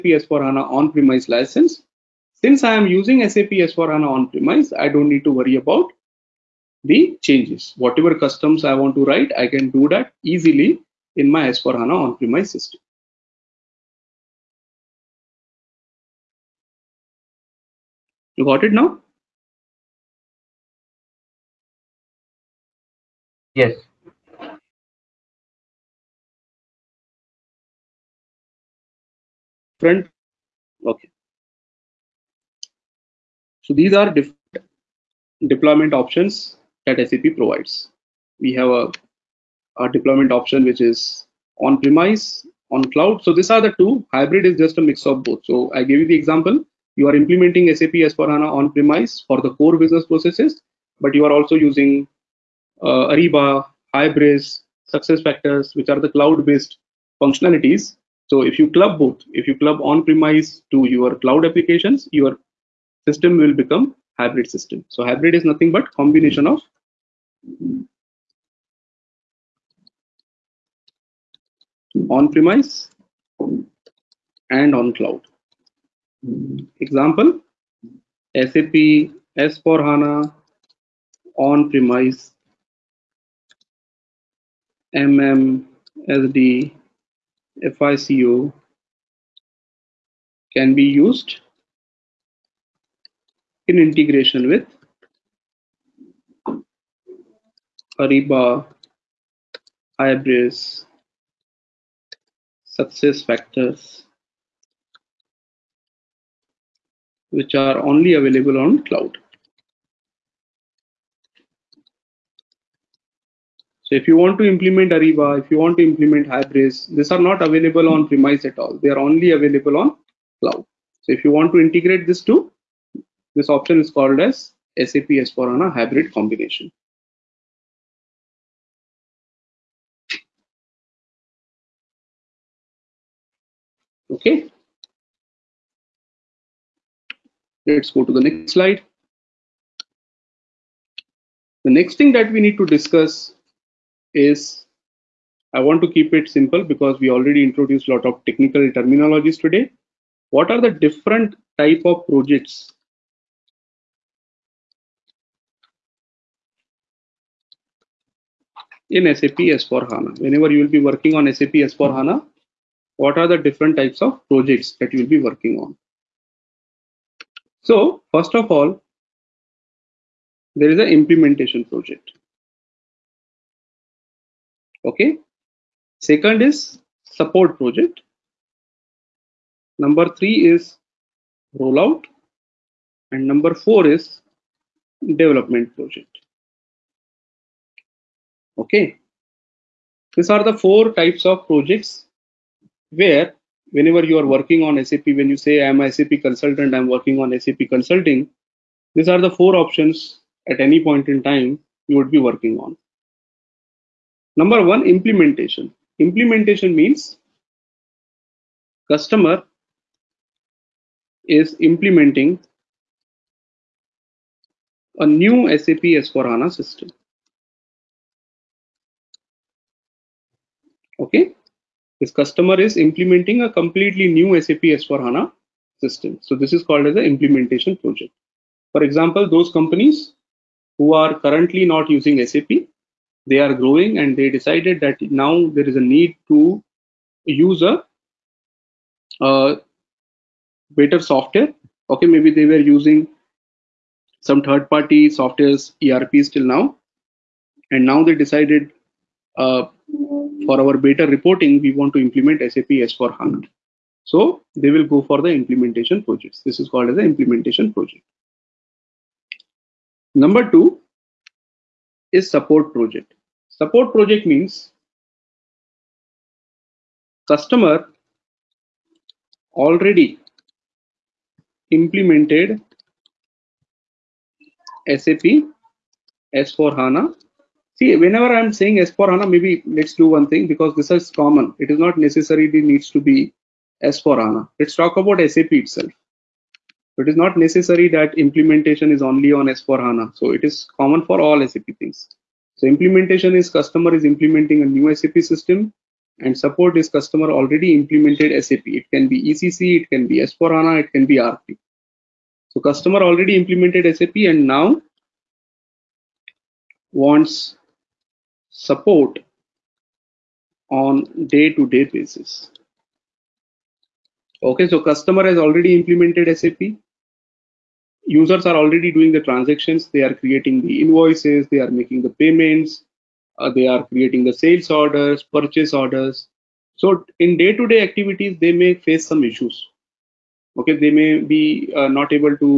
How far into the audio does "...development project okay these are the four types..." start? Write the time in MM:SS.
03:05.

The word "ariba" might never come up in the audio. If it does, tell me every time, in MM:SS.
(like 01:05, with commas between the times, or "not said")
00:53, 01:37, 01:54.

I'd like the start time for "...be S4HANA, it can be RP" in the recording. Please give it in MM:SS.
05:00.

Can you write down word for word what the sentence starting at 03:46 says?
So this is called as an implementation project.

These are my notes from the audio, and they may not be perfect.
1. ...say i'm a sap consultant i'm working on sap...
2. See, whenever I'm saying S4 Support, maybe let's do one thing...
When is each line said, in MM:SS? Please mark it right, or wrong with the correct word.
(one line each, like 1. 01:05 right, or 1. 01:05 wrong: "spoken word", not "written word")
1. 03:15 right
2. 04:37 wrong: "HANA", not "Support".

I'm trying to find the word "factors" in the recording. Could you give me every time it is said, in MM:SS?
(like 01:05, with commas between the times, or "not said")
00:55, 01:43.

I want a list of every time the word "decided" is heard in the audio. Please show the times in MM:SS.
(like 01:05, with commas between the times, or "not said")
03:54, 04:08.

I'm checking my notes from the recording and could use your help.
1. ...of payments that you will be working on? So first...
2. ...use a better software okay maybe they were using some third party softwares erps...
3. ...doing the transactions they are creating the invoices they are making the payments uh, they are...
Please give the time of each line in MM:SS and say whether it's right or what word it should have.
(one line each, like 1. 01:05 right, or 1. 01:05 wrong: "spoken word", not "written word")
1. 02:44 wrong: "projects", not "payments"
2. 03:57 right
3. 05:18 right.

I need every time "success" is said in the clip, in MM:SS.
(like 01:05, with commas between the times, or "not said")
00:54, 01:42.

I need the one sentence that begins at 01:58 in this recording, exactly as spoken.
They are only available on cloud.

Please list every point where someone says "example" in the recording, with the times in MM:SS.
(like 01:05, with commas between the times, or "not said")
00:46, 01:16, 03:48.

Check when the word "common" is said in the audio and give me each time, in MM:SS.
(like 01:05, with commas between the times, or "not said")
04:41, 04:50.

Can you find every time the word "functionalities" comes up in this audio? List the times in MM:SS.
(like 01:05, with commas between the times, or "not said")
00:57.